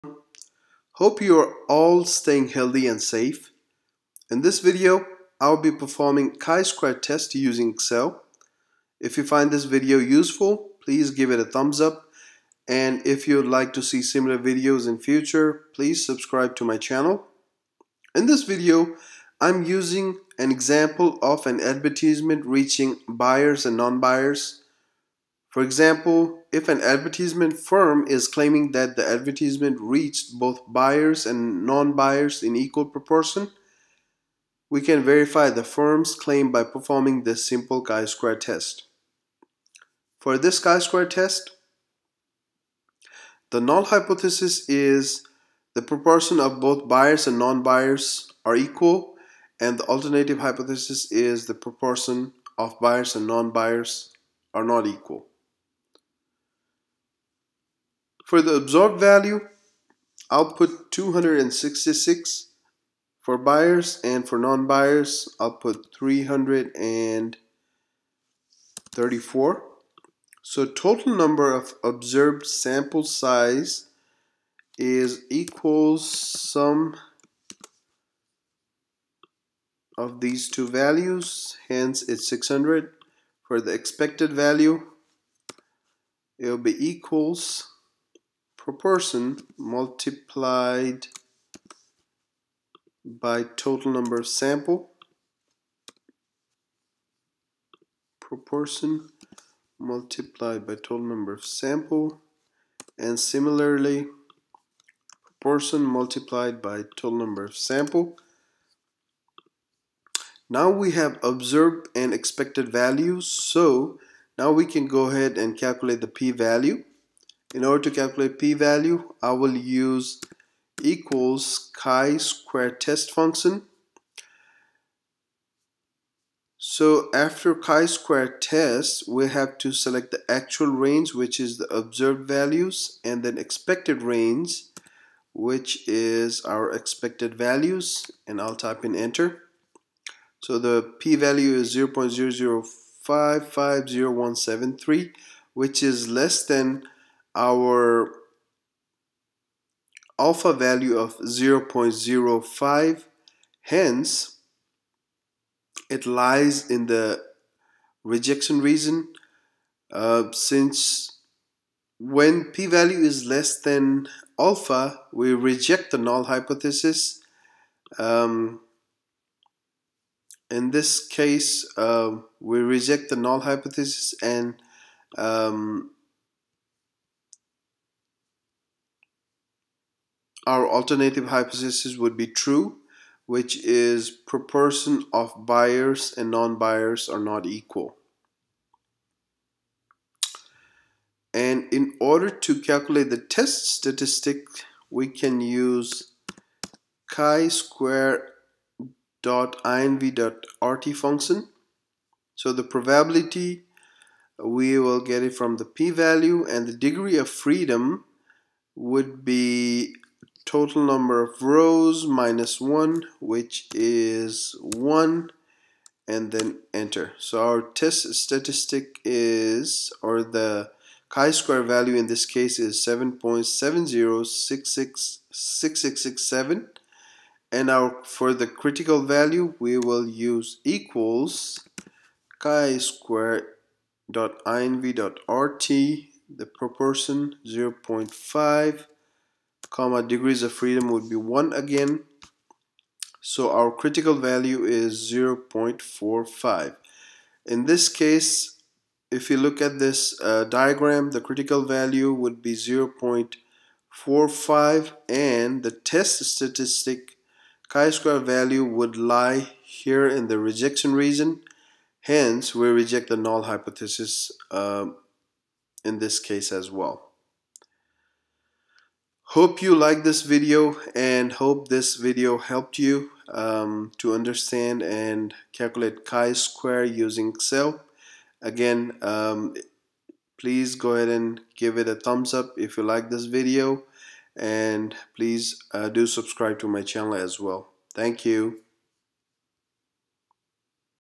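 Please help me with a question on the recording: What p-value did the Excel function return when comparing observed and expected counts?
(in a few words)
0.00550173.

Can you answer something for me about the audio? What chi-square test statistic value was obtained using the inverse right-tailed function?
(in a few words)
7.70666667.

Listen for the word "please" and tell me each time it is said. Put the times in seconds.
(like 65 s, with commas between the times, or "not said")
10 s, 15 s, 280 s, 285 s.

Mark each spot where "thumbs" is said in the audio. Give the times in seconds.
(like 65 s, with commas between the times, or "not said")
11 s, 281 s.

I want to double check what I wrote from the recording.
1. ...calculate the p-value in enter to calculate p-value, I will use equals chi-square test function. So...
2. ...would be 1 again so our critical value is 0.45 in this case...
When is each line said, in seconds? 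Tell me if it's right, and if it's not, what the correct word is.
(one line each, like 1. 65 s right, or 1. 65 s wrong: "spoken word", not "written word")
1. 115 s wrong: "order", not "enter"
2. 240 s right.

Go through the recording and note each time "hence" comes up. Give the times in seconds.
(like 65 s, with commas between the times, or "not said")
81 s, 153 s, 262 s.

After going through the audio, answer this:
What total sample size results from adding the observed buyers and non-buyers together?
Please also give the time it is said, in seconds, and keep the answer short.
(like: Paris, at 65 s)
600, at 82 s.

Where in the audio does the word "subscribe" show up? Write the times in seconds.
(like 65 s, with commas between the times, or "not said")
16 s, 286 s.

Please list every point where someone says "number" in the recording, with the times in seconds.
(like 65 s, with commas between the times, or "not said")
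71 s, 93 s, 100 s, 107 s, 210 s.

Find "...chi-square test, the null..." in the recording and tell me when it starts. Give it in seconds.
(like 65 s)
40 s.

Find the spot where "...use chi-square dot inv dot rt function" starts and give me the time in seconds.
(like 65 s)
195 s.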